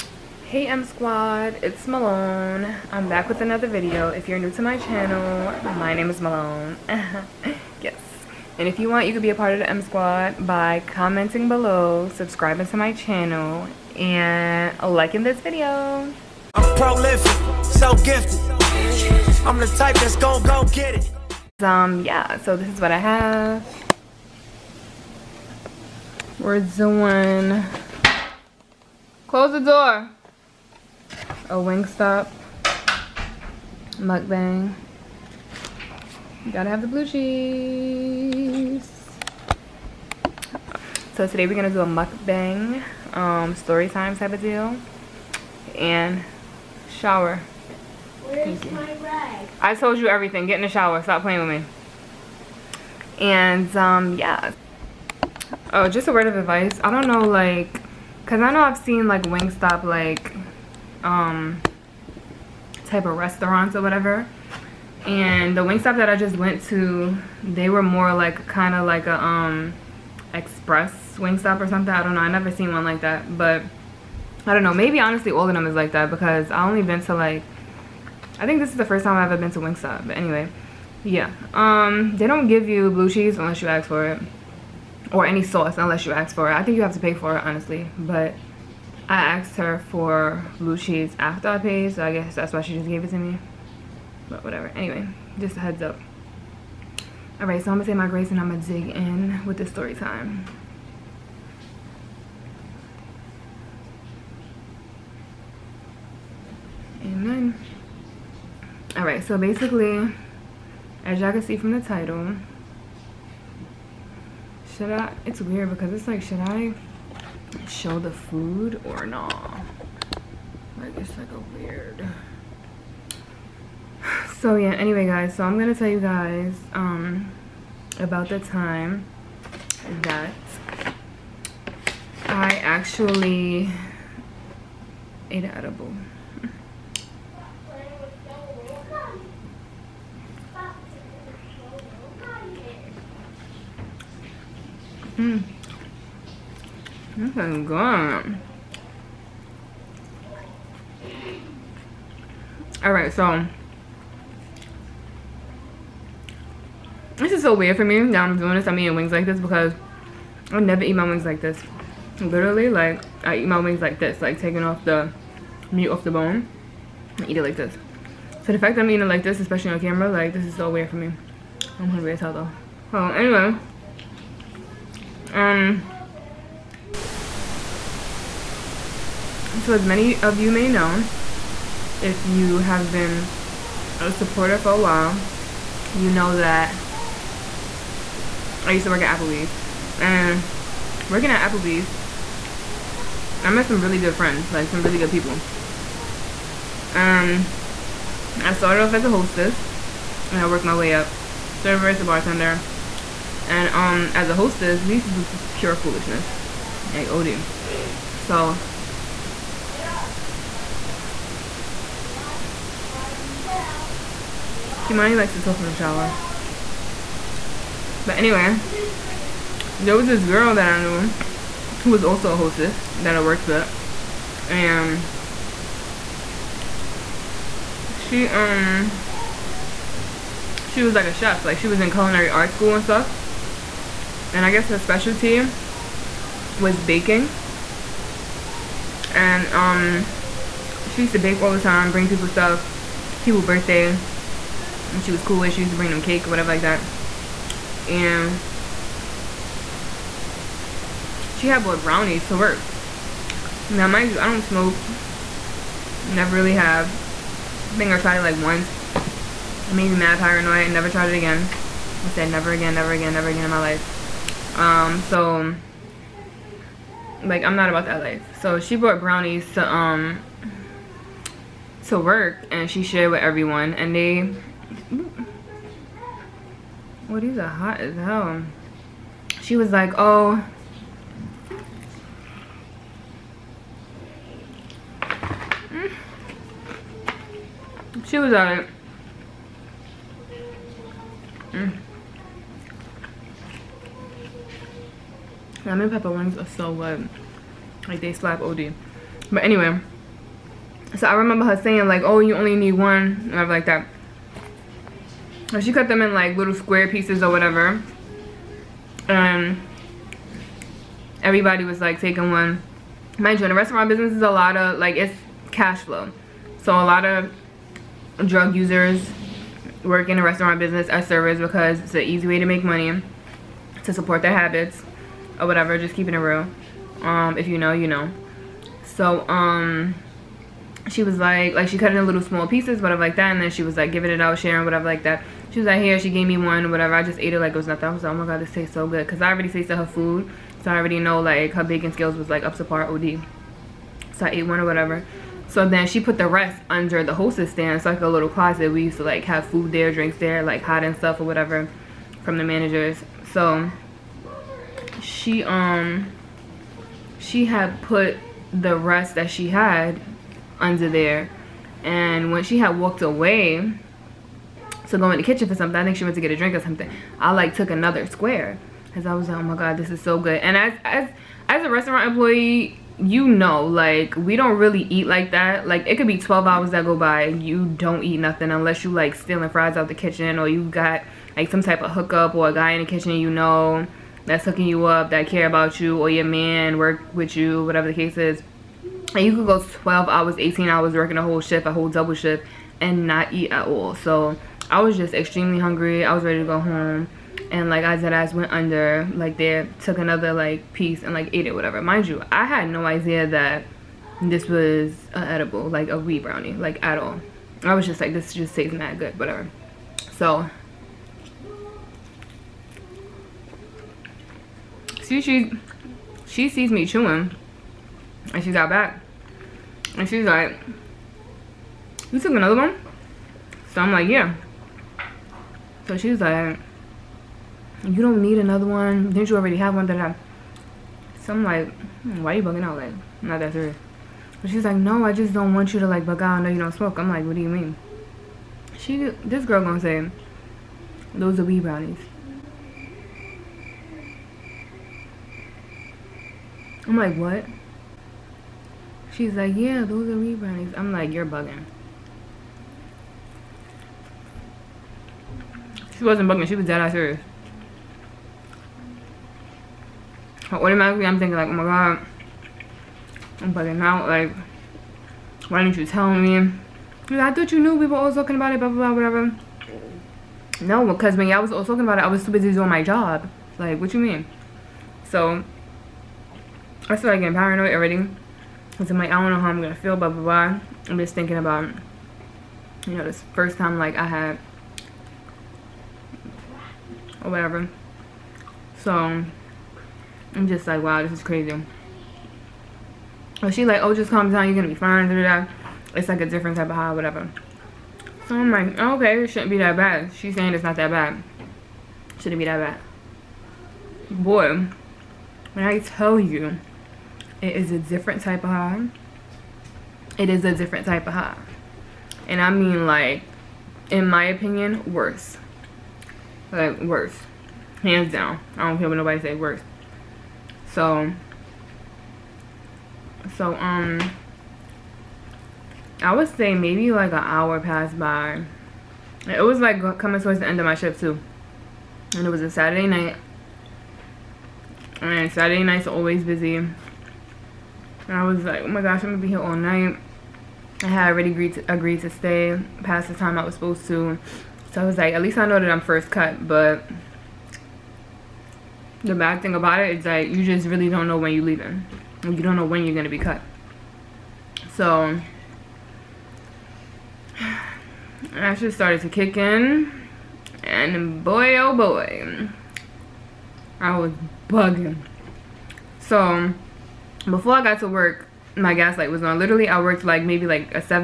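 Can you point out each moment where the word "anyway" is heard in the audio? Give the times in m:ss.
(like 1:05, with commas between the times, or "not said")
1:20, 1:34, 2:04, 2:53, 3:38, 4:59.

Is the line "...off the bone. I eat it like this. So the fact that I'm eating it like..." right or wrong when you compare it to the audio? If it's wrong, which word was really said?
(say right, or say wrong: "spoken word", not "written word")
right.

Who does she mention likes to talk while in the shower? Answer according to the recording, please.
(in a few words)
Kimani.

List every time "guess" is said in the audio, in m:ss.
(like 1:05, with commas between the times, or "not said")
1:32, 3:54.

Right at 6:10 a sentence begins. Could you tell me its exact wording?
And as, as, as a restaurant employee, you know, like we don't really eat like that.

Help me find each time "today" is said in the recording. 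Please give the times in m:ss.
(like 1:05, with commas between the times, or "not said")
0:41.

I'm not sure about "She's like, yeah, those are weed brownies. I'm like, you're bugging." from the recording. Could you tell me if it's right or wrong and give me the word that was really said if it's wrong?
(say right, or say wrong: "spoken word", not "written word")
right.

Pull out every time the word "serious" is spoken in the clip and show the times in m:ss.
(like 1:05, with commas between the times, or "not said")
7:13, 7:36.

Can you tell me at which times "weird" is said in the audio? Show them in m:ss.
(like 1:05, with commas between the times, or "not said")
1:55, 2:01, 2:37, 2:50.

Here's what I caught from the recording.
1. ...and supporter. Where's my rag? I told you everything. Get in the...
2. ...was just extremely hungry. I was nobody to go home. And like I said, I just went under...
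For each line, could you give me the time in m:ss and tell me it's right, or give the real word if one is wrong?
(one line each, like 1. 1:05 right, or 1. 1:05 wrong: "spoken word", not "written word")
1. 0:45 wrong: "shower", not "supporter"
2. 6:34 wrong: "ready", not "nobody".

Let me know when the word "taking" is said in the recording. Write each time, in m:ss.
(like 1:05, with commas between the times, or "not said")
2:44, 5:11.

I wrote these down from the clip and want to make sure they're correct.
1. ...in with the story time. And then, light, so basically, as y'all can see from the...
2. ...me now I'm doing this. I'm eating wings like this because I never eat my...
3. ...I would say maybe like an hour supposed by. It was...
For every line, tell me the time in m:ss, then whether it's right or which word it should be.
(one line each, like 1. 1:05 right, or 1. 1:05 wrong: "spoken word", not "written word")
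1. 1:38 wrong: "alright", not "light"
2. 2:37 right
3. 8:46 wrong: "passed", not "supposed".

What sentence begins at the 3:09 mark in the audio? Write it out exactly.
And working at Applebee's, I met some really good friends, like some really good people.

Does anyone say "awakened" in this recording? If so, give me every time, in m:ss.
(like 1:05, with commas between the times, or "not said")
not said.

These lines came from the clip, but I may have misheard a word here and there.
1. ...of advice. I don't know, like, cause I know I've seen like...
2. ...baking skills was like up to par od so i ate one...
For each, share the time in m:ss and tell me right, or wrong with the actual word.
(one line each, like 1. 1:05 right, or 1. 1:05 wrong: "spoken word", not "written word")
1. 0:56 right
2. 5:41 right.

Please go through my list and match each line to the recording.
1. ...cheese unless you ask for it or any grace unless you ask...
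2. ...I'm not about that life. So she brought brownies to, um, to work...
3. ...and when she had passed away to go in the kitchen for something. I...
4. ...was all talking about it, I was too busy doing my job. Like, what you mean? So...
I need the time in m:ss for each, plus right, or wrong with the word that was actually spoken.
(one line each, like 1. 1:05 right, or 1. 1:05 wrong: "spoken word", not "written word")
1. 1:23 wrong: "sauce", not "grace"
2. 4:27 right
3. 6:01 wrong: "walked", not "passed"
4. 7:51 right.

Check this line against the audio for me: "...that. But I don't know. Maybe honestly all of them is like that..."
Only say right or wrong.
right.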